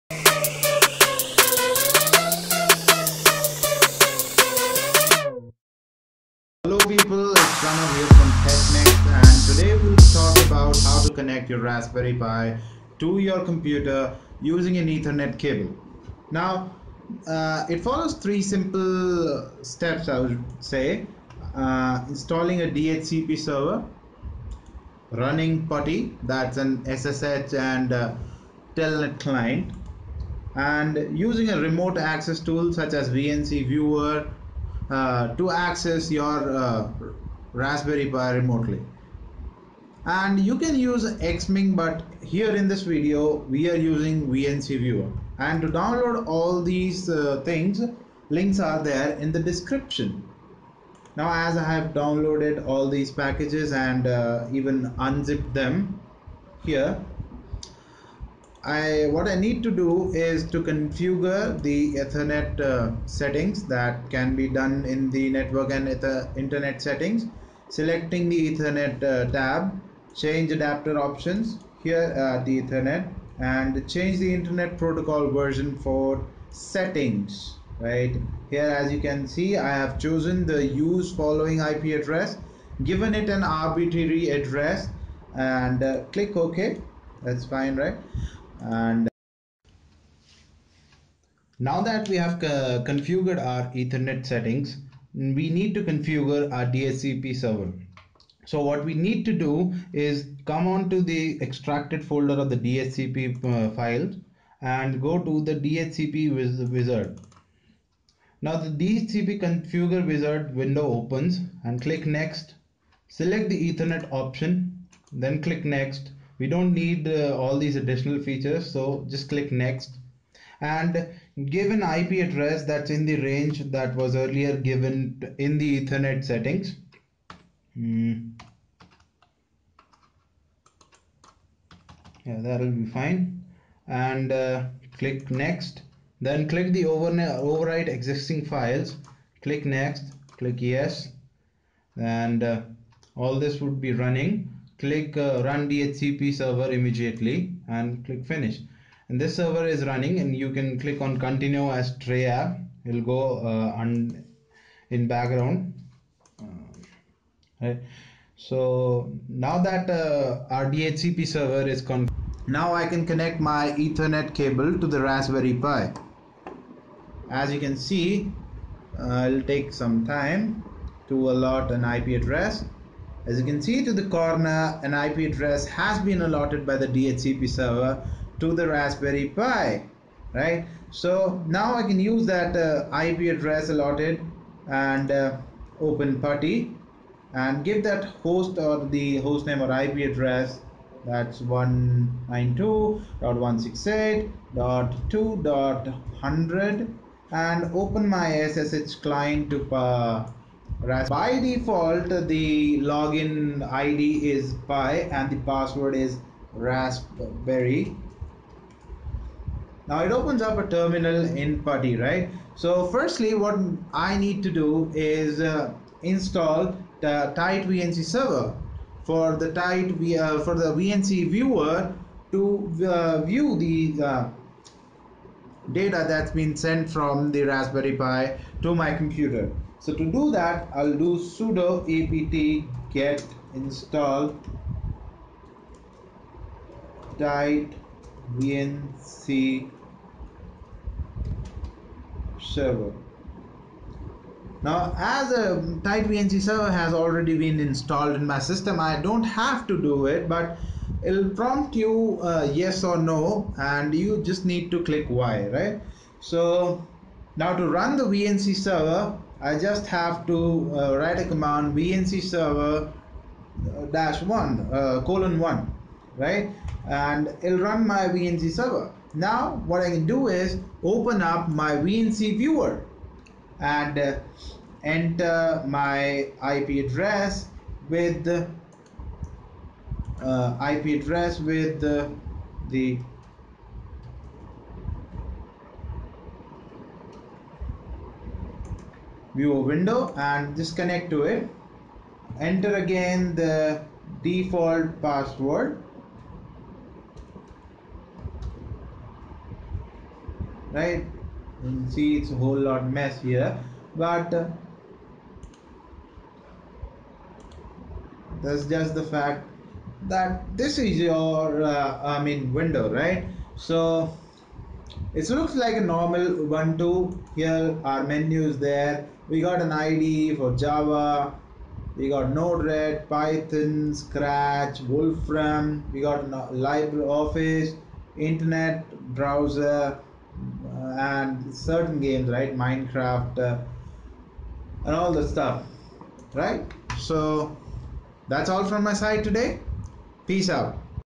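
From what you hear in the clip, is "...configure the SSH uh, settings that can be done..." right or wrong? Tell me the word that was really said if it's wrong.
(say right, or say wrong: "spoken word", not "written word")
wrong: "Ethernet", not "SSH".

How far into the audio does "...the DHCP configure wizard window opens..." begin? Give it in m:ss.
1:48.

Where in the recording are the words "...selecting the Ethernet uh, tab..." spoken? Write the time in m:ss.
1:07.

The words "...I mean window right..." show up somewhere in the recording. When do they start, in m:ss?
5:12.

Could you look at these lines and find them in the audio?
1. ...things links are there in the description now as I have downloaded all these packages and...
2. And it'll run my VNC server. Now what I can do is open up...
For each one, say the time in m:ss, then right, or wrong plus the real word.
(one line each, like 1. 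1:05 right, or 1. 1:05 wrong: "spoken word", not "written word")
1. 0:47 right
2. 4:26 right.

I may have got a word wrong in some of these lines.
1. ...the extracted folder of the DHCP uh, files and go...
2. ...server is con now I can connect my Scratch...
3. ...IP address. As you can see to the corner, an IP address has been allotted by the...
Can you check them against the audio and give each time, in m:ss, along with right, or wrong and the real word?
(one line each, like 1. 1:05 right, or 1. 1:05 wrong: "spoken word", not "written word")
1. 1:41 right
2. 2:41 wrong: "Ethernet", not "Scratch"
3. 2:51 right.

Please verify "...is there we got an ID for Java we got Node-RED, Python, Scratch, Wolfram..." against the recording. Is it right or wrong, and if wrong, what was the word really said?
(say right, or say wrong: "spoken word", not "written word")
right.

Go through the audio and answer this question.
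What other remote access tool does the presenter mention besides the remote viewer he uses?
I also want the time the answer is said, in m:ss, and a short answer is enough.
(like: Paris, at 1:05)
Xming, at 0:41.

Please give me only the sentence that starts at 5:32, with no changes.
Minecraft uh, and all the stuff, right?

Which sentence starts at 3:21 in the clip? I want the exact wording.
By default the login ID is pi and the password is raspberry.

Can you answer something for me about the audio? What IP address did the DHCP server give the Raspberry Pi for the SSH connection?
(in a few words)
192.168.2.100.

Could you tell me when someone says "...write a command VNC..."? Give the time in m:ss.
4:20.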